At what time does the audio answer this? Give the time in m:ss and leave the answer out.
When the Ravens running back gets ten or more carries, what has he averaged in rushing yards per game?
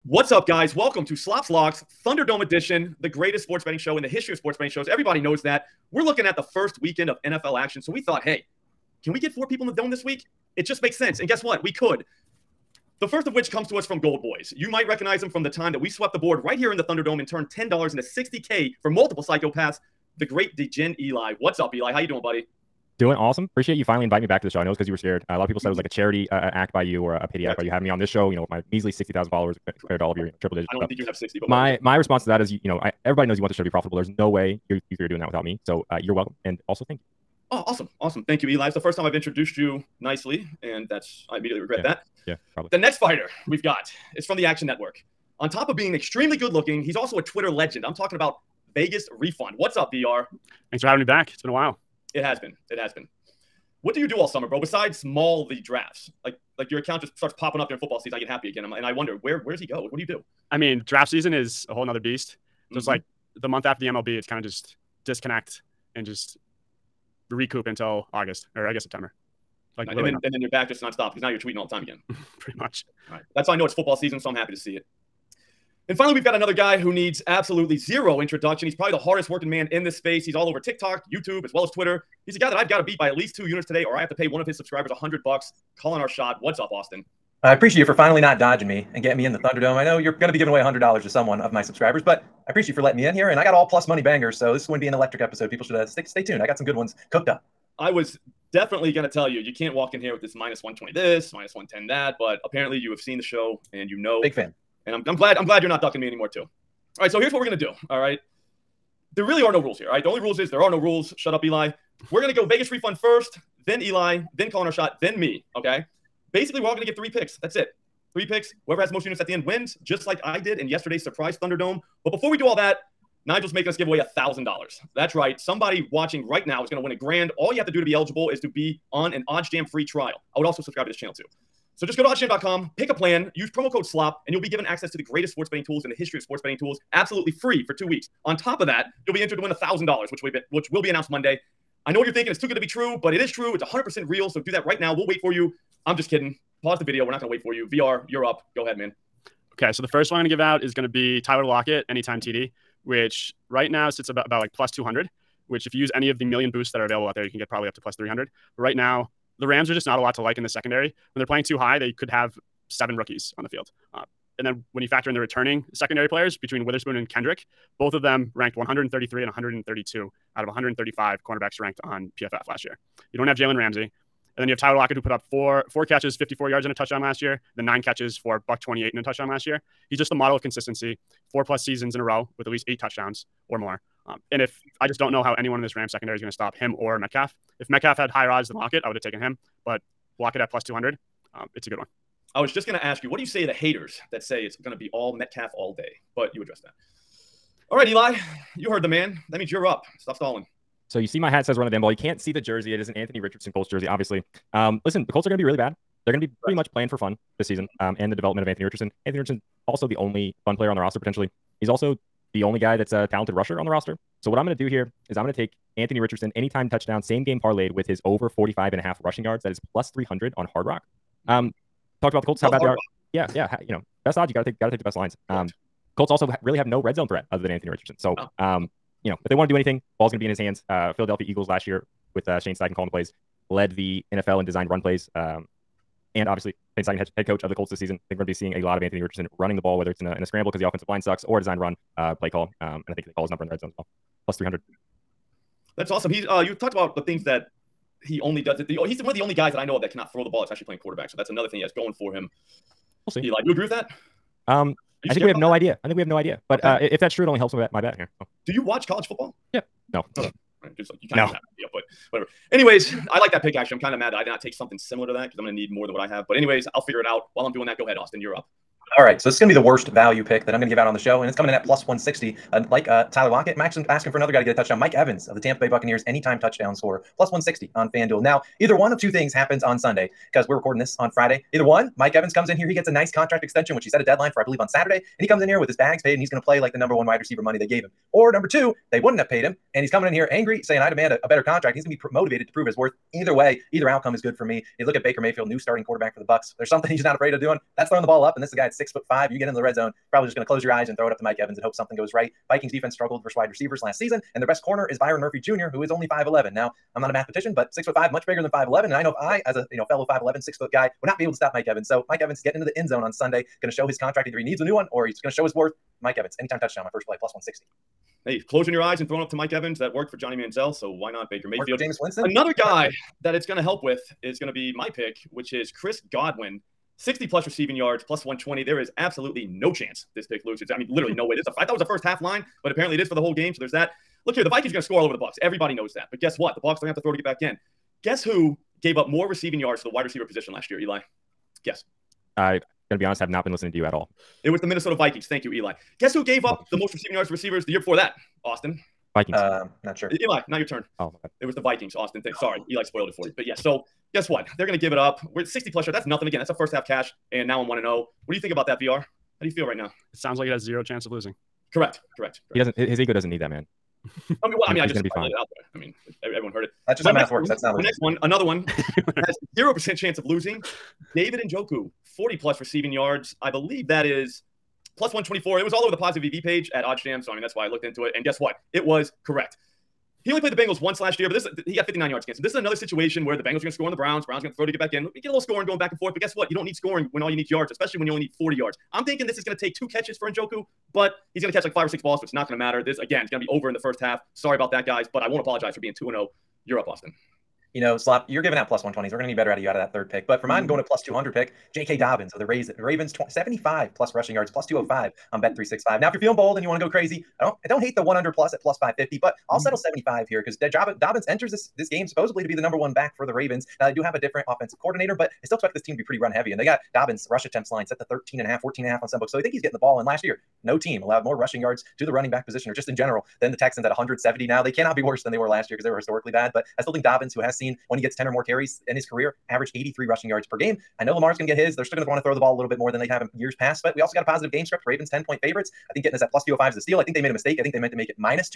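7:09.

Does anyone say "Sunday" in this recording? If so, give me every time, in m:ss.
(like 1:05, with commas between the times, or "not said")
4:39, 5:13.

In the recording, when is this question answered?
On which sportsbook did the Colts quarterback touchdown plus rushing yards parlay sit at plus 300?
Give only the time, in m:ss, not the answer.
3:40.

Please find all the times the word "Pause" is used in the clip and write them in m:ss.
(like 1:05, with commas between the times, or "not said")
2:26.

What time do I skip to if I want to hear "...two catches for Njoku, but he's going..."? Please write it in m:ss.
6:29.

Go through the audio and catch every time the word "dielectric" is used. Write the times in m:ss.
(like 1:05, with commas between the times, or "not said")
not said.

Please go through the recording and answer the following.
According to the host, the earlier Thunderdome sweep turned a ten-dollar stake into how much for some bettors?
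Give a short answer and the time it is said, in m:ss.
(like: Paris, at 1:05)
60K, at 0:18.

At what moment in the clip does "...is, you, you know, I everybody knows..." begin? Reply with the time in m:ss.
0:32.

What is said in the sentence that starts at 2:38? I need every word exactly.
But right now, the Rams are just not a lot to like in the secondary.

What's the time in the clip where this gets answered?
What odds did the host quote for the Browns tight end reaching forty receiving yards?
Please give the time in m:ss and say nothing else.
6:14.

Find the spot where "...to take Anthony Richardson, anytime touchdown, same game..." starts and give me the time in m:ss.
3:35.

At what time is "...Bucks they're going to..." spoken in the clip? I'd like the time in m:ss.
5:36.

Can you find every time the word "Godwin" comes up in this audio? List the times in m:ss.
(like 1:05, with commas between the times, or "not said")
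5:26.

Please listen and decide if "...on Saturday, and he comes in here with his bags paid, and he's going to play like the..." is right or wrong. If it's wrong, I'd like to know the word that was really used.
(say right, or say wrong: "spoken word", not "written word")
right.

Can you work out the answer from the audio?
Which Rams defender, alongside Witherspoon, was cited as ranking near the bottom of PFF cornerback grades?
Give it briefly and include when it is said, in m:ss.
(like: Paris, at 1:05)
Kendrick, at 2:47.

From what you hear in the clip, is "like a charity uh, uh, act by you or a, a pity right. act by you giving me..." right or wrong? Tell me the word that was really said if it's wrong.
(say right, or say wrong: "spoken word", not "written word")
wrong: "having", not "giving".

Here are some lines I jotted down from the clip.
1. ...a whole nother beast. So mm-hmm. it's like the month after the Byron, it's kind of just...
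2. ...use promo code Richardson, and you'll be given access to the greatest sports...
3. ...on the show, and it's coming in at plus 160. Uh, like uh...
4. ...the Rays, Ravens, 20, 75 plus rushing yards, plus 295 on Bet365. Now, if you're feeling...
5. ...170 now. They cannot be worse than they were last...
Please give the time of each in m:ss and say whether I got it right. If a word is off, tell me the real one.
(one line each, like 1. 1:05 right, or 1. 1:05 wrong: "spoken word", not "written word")
1. 1:01 wrong: "MLB", not "Byron"
2. 2:13 wrong: "SLOP", not "Richardson"
3. 4:30 right
4. 6:42 wrong: "205", not "295"
5. 7:03 right.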